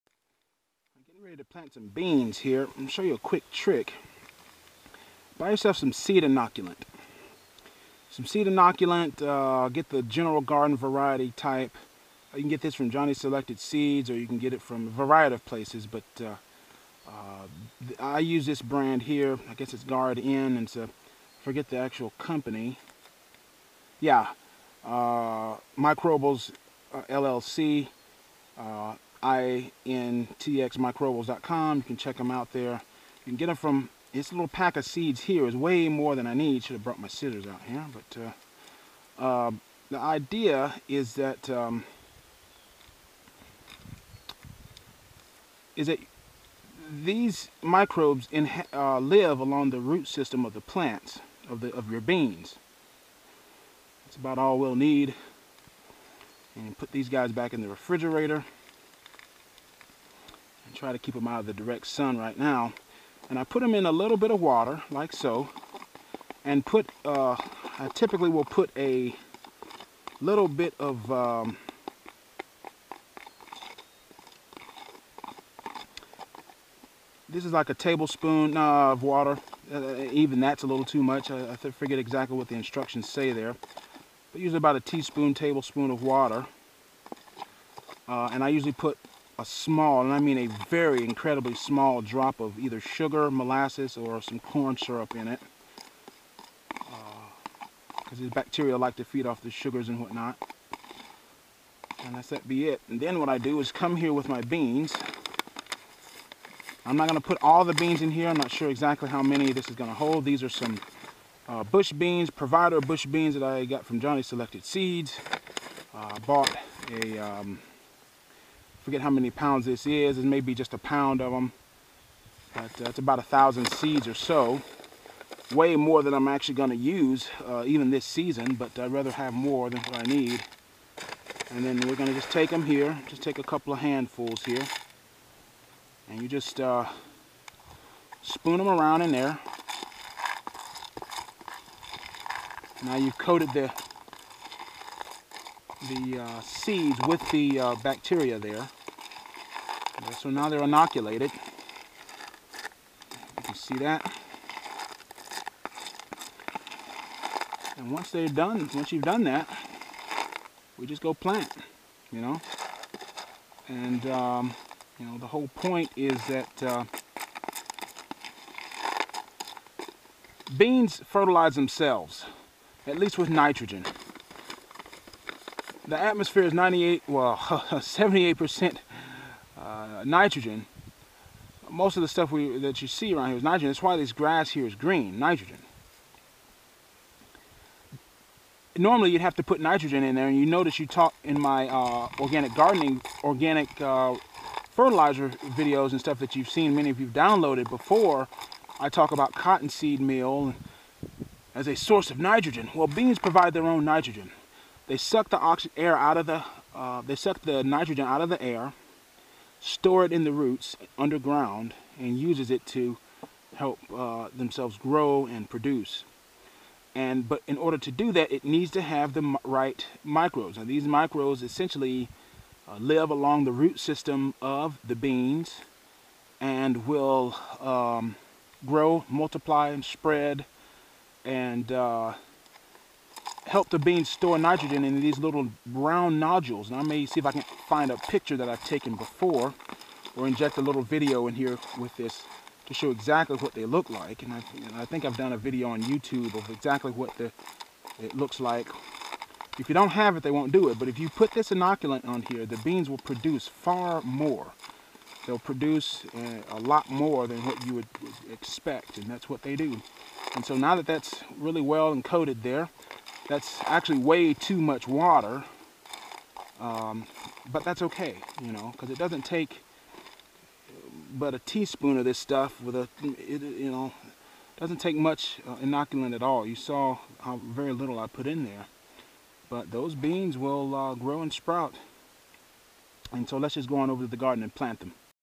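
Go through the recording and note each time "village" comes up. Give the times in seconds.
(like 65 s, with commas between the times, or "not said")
not said.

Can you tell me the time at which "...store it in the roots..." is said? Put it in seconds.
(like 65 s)
209 s.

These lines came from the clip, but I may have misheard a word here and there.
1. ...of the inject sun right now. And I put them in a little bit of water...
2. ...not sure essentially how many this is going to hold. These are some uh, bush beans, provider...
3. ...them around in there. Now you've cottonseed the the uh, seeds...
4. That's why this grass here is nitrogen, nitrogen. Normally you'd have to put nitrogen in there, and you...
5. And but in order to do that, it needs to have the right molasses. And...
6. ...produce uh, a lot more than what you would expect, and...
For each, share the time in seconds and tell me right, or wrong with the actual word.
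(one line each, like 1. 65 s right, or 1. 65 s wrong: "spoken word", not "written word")
1. 61 s wrong: "direct", not "inject"
2. 108 s wrong: "exactly", not "essentially"
3. 138 s wrong: "coated", not "cottonseed"
4. 183 s wrong: "green", not "nitrogen"
5. 216 s wrong: "microbes", not "molasses"
6. 255 s right.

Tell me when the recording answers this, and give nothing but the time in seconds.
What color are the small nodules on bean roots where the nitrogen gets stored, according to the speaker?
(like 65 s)
235 s.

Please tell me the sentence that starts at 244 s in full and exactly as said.
And I, and I think I've done a video on YouTube of exactly what the, it looks like.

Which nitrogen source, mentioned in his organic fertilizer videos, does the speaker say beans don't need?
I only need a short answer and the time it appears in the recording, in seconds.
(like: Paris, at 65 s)
Cottonseed meal, at 199 s.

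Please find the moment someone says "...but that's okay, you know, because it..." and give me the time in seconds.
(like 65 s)
267 s.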